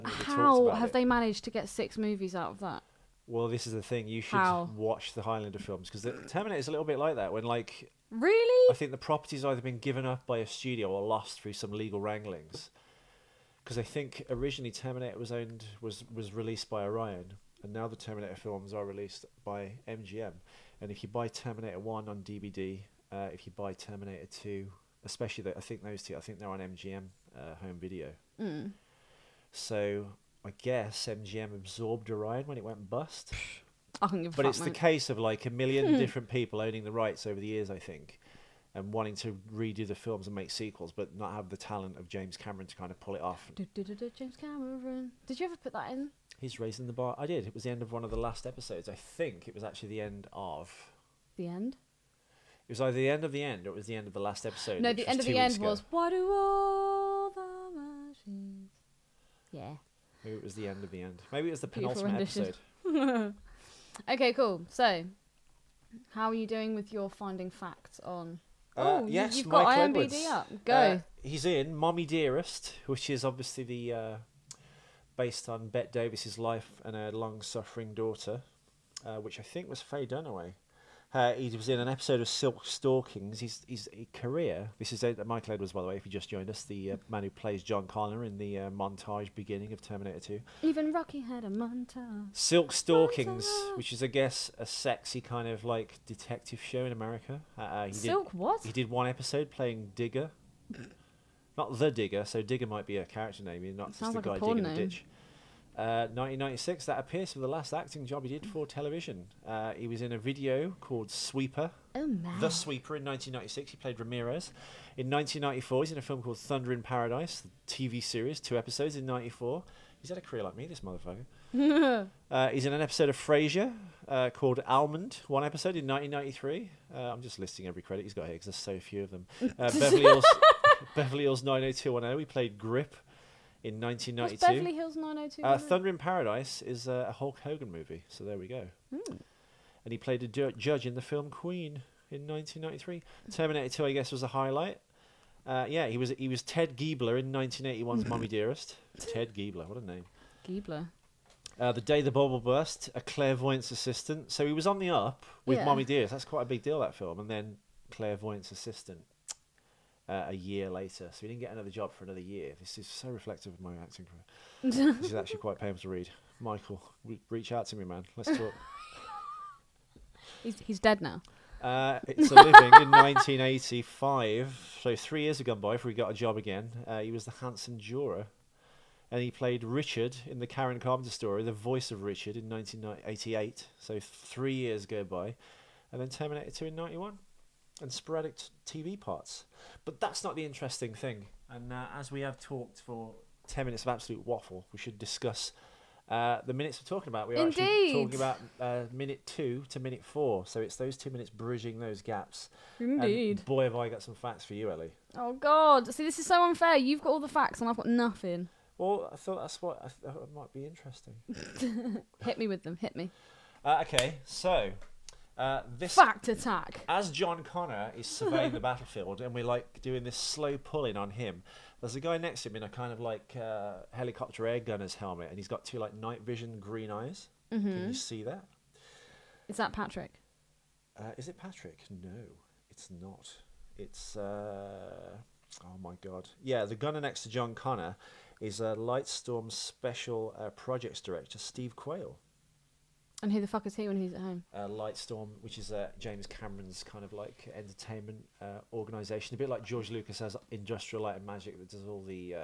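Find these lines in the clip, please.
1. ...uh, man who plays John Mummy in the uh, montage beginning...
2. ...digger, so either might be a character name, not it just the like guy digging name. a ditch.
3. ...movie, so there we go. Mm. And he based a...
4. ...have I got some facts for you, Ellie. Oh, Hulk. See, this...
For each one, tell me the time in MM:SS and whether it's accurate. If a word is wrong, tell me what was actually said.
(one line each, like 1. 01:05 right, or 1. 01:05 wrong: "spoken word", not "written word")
1. 01:26 wrong: "Connor", not "Mummy"
2. 01:41 wrong: "digger", not "either"
3. 02:17 wrong: "played", not "based"
4. 03:23 wrong: "God", not "Hulk".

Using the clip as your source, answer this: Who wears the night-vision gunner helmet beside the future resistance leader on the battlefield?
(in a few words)
Steve Quale.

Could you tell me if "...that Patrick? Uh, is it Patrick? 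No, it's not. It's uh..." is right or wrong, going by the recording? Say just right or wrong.
right.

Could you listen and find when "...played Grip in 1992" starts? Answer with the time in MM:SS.
02:12.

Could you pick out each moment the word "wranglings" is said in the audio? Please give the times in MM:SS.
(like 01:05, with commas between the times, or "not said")
00:11.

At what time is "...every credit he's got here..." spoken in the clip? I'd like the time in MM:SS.
02:07.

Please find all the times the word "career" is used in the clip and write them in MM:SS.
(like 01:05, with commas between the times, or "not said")
01:24, 02:00, 02:44.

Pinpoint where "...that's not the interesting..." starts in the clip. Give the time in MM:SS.
03:09.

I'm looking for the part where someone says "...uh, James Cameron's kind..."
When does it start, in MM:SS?
04:05.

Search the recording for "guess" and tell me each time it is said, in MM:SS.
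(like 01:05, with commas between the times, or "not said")
00:30, 01:34, 02:23.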